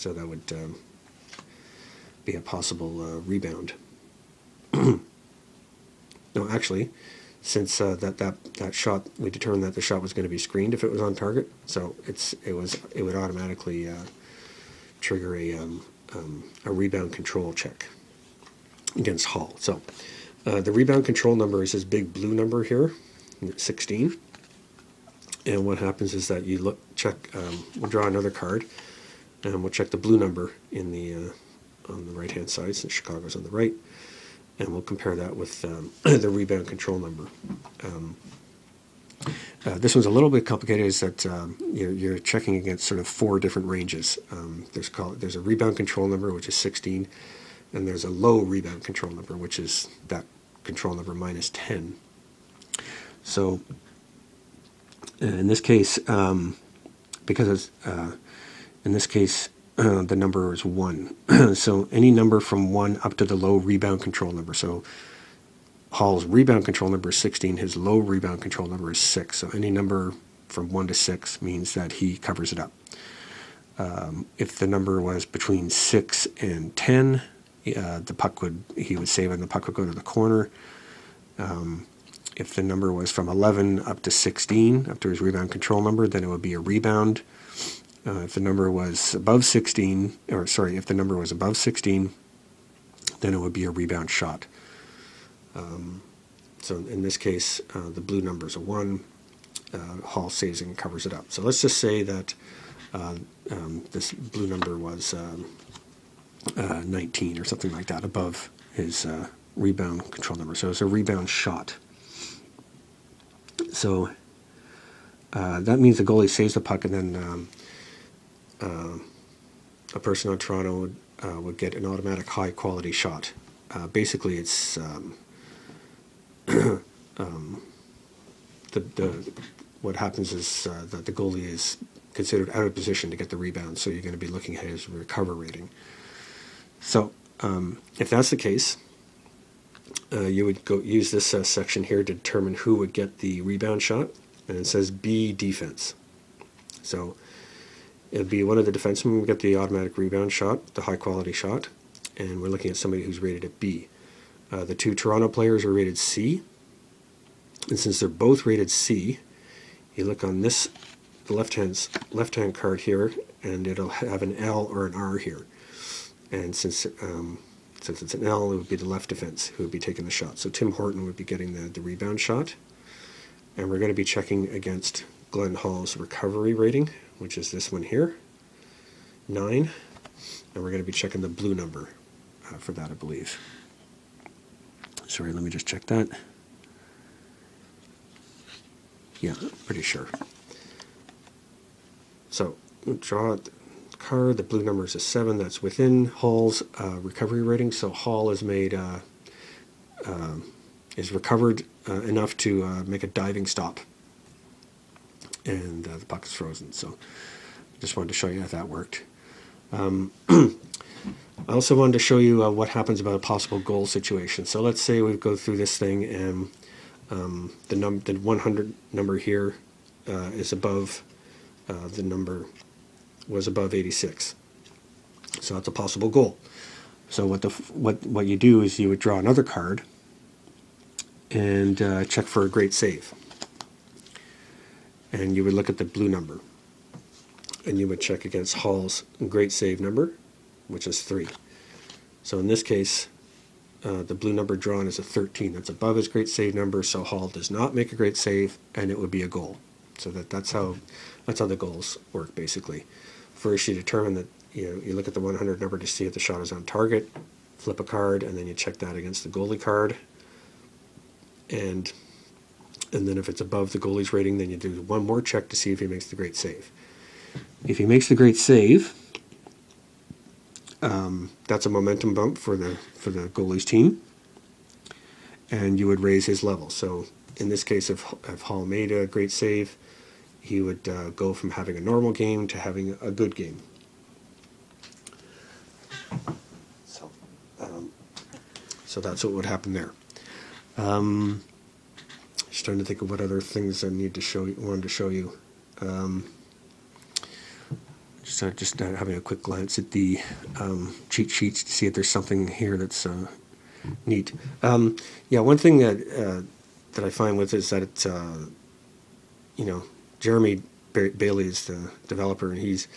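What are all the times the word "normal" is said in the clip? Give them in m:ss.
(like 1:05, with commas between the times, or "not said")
4:41.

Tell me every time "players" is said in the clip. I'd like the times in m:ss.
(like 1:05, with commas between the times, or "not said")
2:35.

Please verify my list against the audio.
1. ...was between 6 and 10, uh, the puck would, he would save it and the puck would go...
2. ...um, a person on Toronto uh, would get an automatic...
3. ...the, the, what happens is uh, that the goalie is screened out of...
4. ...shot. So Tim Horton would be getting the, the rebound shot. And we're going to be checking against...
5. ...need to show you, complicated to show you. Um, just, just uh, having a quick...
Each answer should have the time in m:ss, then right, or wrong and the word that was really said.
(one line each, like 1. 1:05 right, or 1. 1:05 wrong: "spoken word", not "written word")
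1. 1:15 right
2. 1:58 right
3. 2:08 wrong: "considered", not "screened"
4. 2:50 right
5. 4:53 wrong: "wanted", not "complicated".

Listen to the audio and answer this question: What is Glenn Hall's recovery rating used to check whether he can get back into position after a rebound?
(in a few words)
9.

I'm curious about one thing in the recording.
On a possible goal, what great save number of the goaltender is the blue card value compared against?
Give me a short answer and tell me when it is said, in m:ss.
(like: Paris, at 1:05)
3, at 4:01.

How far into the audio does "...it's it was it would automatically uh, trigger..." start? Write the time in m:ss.
0:12.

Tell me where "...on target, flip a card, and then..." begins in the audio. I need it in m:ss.
4:16.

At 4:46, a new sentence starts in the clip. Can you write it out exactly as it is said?
So, um, so that's what would happen there.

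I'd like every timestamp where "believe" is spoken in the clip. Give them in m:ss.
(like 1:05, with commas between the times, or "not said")
3:02.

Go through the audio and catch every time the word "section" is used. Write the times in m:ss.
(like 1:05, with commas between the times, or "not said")
2:21.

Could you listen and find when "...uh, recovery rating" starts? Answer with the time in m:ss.
3:16.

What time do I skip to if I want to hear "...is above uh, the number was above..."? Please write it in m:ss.
3:40.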